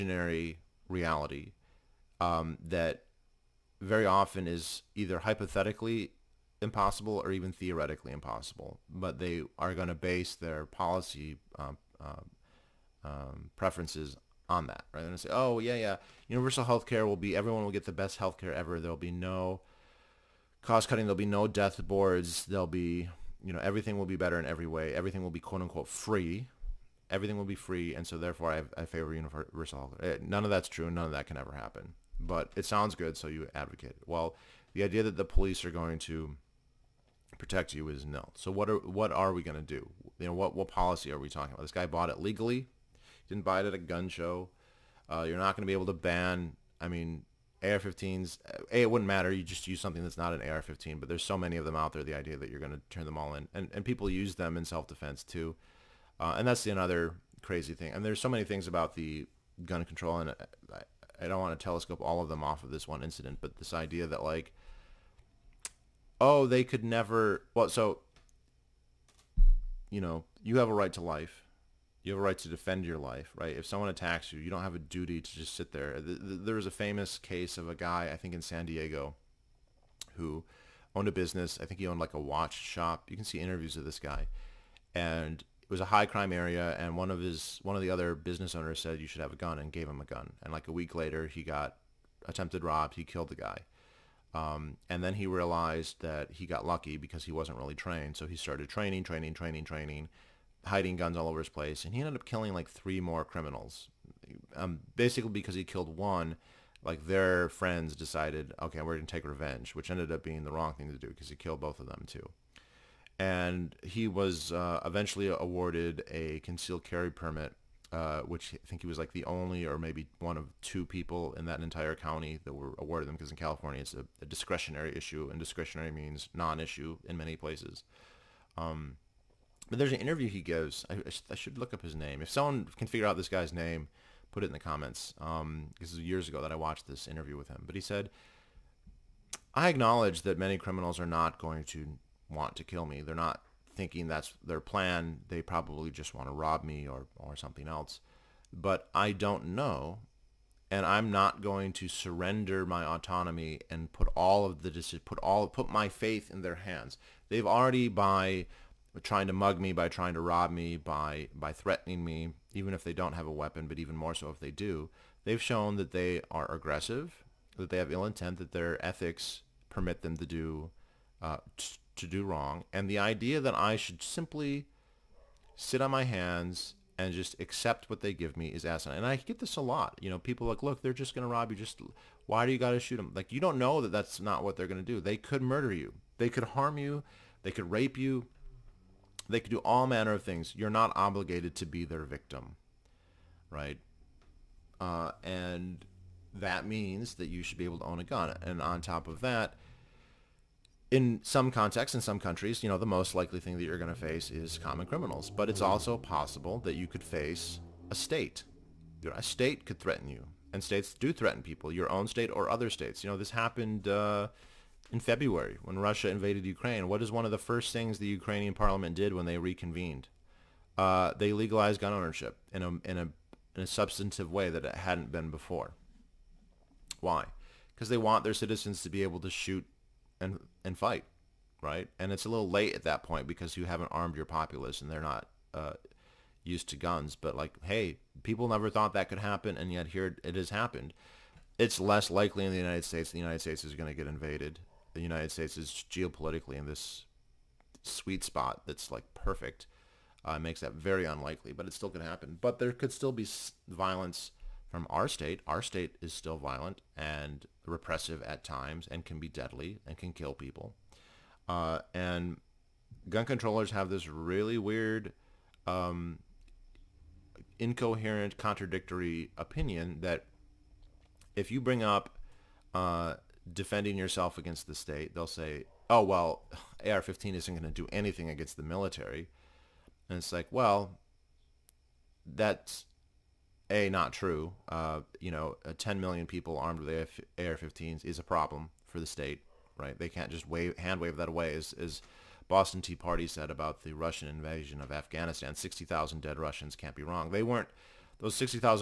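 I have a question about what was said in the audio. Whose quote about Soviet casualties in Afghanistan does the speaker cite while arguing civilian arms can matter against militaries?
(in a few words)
Boston T. Party.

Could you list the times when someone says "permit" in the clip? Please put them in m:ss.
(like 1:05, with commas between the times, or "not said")
1:57, 2:49.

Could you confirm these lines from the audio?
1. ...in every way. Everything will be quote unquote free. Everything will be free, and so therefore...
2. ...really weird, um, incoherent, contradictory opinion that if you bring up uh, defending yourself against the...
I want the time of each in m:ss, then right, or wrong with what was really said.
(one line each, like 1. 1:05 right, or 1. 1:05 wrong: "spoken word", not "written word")
1. 0:24 right
2. 4:24 right.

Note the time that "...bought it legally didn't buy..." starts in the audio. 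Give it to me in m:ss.
0:41.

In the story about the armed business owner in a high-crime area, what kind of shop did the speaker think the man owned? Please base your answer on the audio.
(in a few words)
Watch shop.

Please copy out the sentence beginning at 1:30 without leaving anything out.
And like a week later, he got attempted robbed.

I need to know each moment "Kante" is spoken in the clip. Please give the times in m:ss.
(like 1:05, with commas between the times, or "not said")
not said.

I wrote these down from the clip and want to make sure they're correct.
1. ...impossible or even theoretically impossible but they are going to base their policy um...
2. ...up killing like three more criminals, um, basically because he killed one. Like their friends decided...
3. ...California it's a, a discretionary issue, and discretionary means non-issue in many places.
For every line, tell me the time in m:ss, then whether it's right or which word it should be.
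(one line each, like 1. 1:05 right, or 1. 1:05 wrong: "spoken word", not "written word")
1. 0:06 right
2. 1:42 right
3. 2:03 right.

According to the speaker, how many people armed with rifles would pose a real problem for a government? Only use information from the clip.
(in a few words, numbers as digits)
10 million.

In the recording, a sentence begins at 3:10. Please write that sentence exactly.
You're not obligated to be their victim, right?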